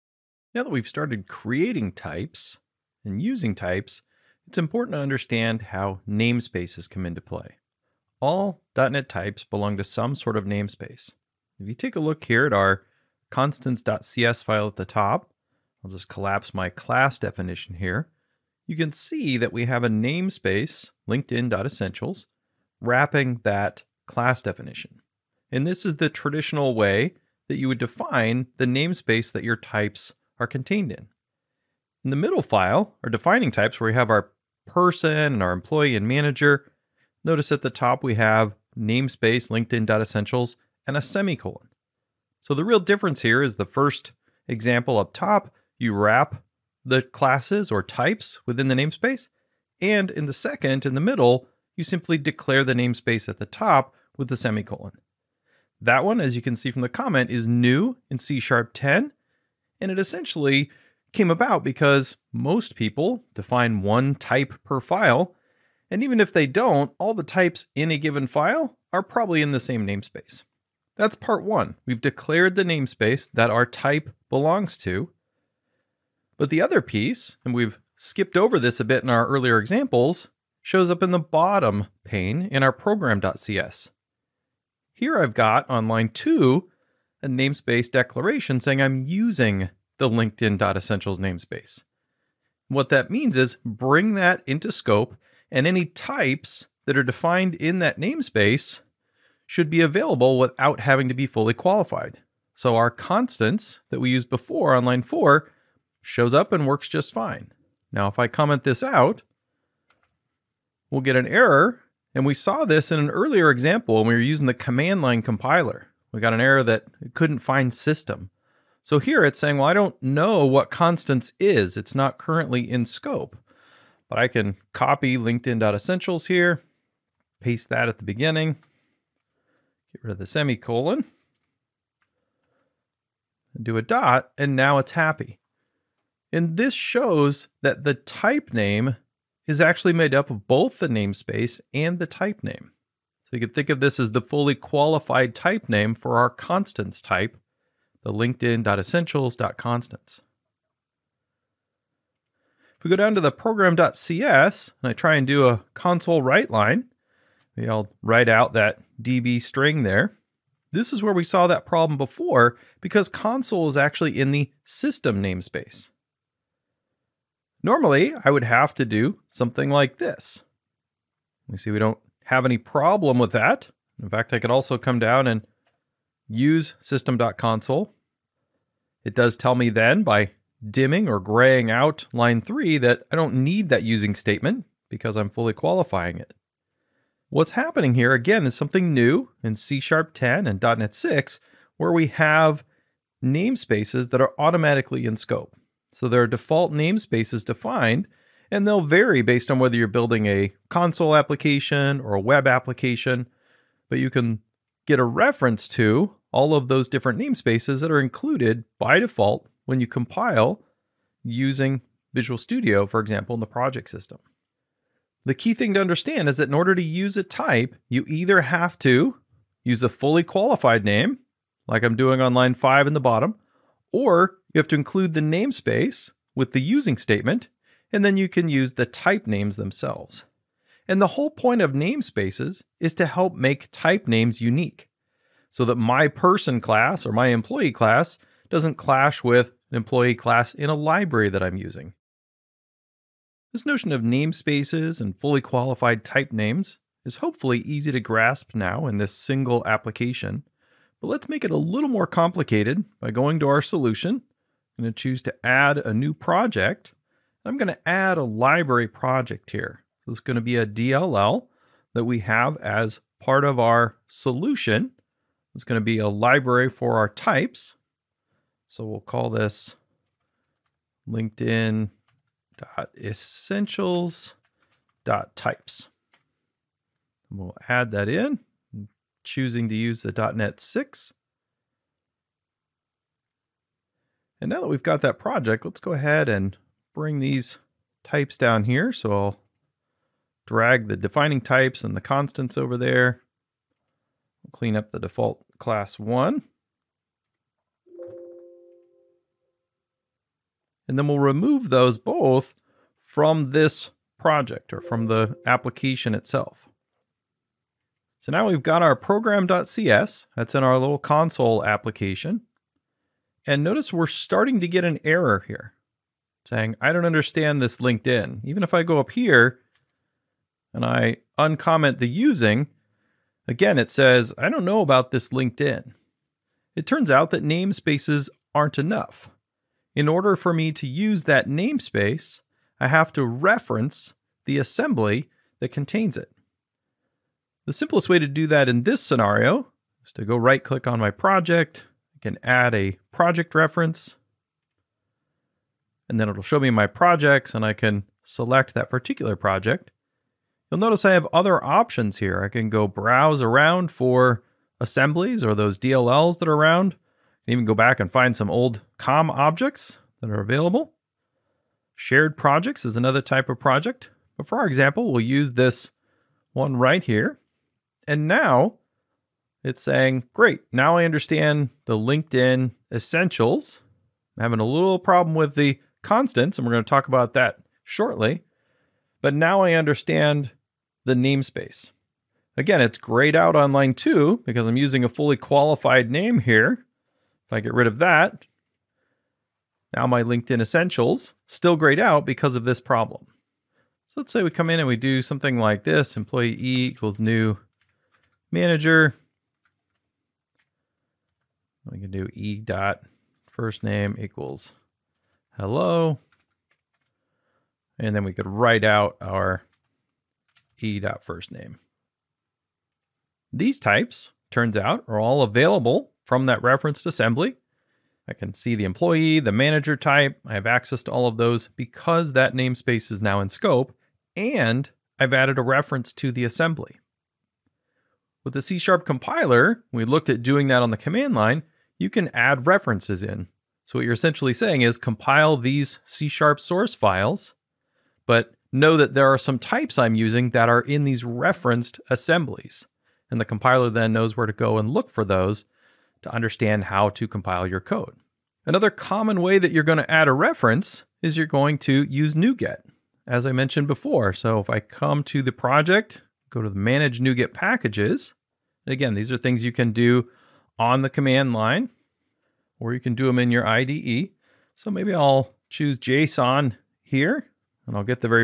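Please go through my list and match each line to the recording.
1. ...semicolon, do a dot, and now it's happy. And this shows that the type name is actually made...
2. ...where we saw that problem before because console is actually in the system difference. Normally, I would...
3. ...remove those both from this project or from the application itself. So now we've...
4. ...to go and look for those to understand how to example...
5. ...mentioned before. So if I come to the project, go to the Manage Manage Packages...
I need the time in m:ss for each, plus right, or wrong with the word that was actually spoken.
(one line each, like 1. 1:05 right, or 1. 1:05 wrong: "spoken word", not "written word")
1. 2:10 right
2. 2:41 wrong: "namespace", not "difference"
3. 5:01 right
4. 7:24 wrong: "compile", not "example"
5. 7:33 wrong: "NuGet", not "Manage".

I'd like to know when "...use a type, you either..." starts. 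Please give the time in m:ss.
3:36.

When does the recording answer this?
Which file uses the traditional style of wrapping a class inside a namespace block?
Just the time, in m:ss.
0:13.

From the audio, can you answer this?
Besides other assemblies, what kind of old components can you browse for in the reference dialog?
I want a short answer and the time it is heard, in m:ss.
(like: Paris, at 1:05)
COM objects, at 5:58.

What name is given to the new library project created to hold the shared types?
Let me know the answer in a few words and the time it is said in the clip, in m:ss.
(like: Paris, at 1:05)
LinkedIn.essentials.types, at 4:31.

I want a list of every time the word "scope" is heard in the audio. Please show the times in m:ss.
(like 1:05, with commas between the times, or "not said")
1:34, 2:02, 3:15, 7:03.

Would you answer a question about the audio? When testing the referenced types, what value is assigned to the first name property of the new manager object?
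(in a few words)
hello.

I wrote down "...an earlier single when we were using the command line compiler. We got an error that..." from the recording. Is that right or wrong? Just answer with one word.
wrong.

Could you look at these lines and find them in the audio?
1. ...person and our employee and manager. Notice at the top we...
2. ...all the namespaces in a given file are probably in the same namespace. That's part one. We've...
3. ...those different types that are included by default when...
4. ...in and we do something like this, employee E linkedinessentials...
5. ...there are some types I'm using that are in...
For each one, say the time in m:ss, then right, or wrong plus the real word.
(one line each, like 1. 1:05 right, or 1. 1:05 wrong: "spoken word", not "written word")
1. 0:34 right
2. 1:06 wrong: "types", not "namespaces"
3. 3:26 wrong: "namespaces", not "types"
4. 6:34 wrong: "equals", not "linkedinessentials"
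5. 7:19 right.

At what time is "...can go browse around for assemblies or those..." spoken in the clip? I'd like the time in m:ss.
5:52.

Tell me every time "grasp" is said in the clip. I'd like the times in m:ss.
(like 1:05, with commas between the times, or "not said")
4:07.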